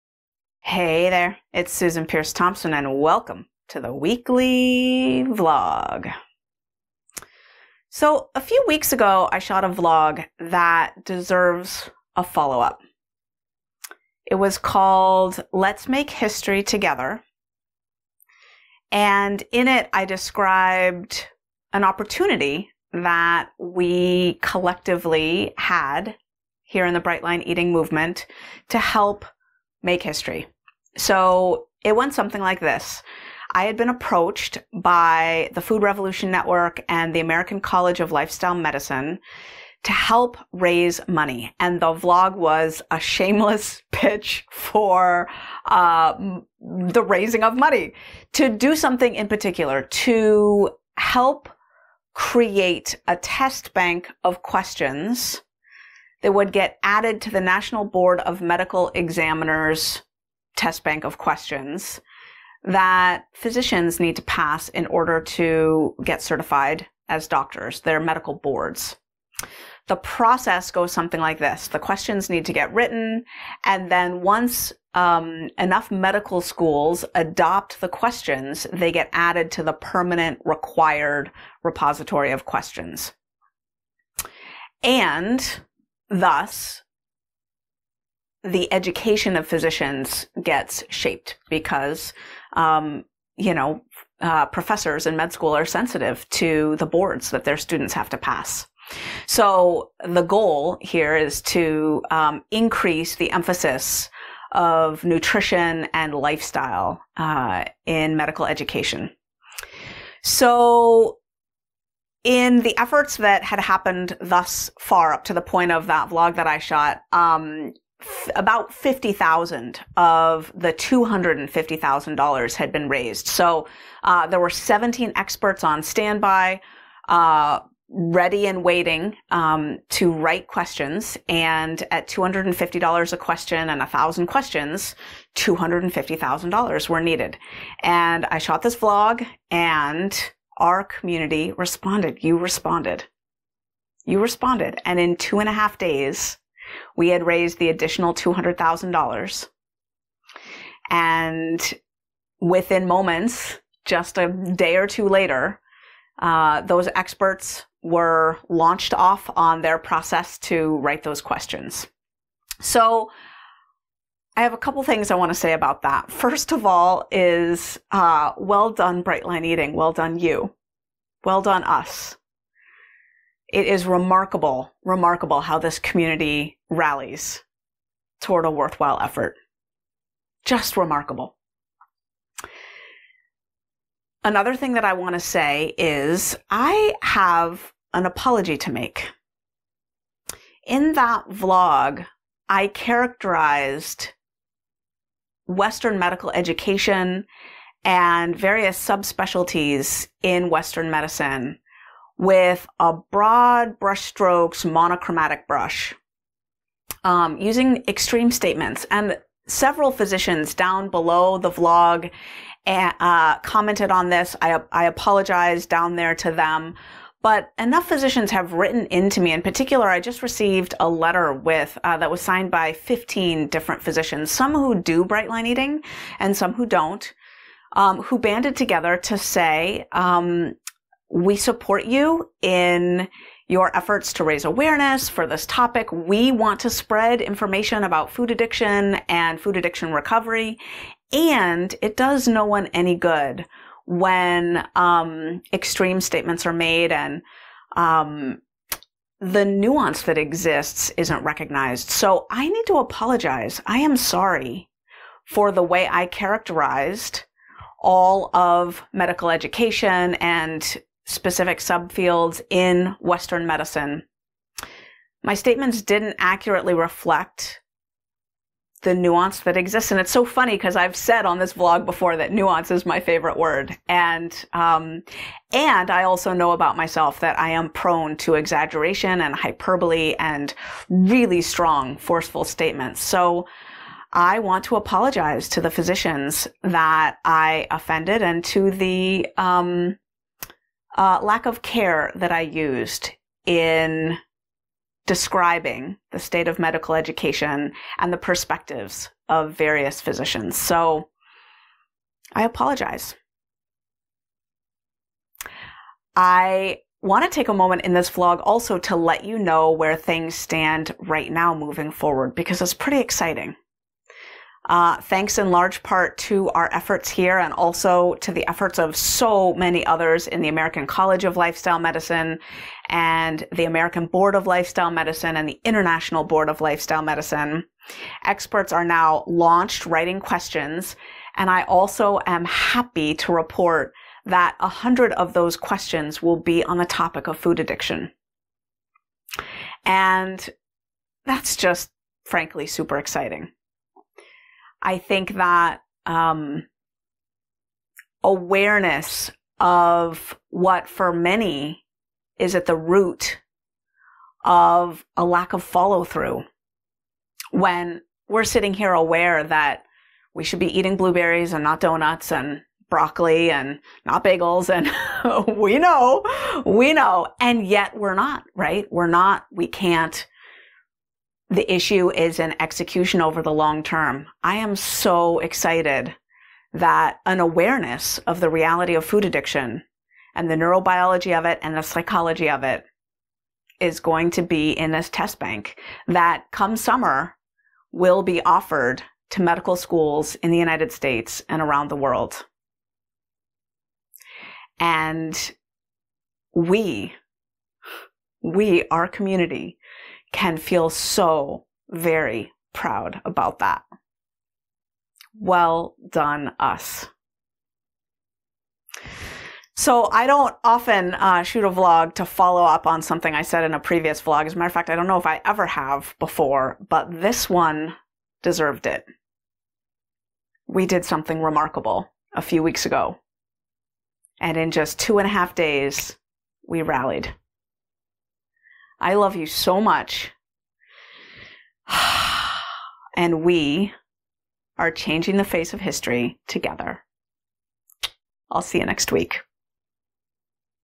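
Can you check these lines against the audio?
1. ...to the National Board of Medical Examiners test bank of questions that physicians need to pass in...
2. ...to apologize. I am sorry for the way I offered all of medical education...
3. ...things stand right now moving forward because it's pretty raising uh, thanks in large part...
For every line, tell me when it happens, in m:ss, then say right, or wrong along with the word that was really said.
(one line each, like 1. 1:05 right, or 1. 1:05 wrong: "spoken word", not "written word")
1. 0:57 right
2. 4:12 wrong: "characterized", not "offered"
3. 5:09 wrong: "exciting", not "raising".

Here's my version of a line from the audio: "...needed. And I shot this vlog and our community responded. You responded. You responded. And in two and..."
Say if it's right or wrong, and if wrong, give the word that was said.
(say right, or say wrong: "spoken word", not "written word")
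right.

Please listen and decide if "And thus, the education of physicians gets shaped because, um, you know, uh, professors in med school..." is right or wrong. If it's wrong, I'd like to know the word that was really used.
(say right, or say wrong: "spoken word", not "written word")
right.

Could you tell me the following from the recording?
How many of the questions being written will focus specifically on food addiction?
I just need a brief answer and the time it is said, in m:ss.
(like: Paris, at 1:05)
a hundred, at 5:34.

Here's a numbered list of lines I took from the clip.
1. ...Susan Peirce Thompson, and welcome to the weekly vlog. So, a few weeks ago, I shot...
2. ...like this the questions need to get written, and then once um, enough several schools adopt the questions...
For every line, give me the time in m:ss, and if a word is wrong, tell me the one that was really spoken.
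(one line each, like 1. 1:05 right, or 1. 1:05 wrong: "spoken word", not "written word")
1. 0:01 right
2. 1:11 wrong: "medical", not "several".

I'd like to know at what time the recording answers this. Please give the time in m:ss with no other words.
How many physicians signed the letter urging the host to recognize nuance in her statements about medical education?
3:42.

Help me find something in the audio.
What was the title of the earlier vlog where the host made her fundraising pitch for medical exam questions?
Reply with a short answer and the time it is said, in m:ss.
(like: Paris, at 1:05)
Let's Make History Together, at 0:15.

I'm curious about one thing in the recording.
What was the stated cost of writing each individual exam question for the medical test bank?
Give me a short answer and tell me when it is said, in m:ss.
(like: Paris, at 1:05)
$250, at 2:12.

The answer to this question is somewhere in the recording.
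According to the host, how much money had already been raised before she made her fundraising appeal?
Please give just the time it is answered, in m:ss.
1:58.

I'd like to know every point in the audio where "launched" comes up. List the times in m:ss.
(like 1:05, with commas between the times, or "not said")
2:38, 5:29.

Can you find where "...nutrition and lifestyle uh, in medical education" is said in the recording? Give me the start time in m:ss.
1:45.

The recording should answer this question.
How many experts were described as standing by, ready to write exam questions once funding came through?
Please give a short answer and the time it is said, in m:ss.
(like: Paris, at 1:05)
17, at 2:04.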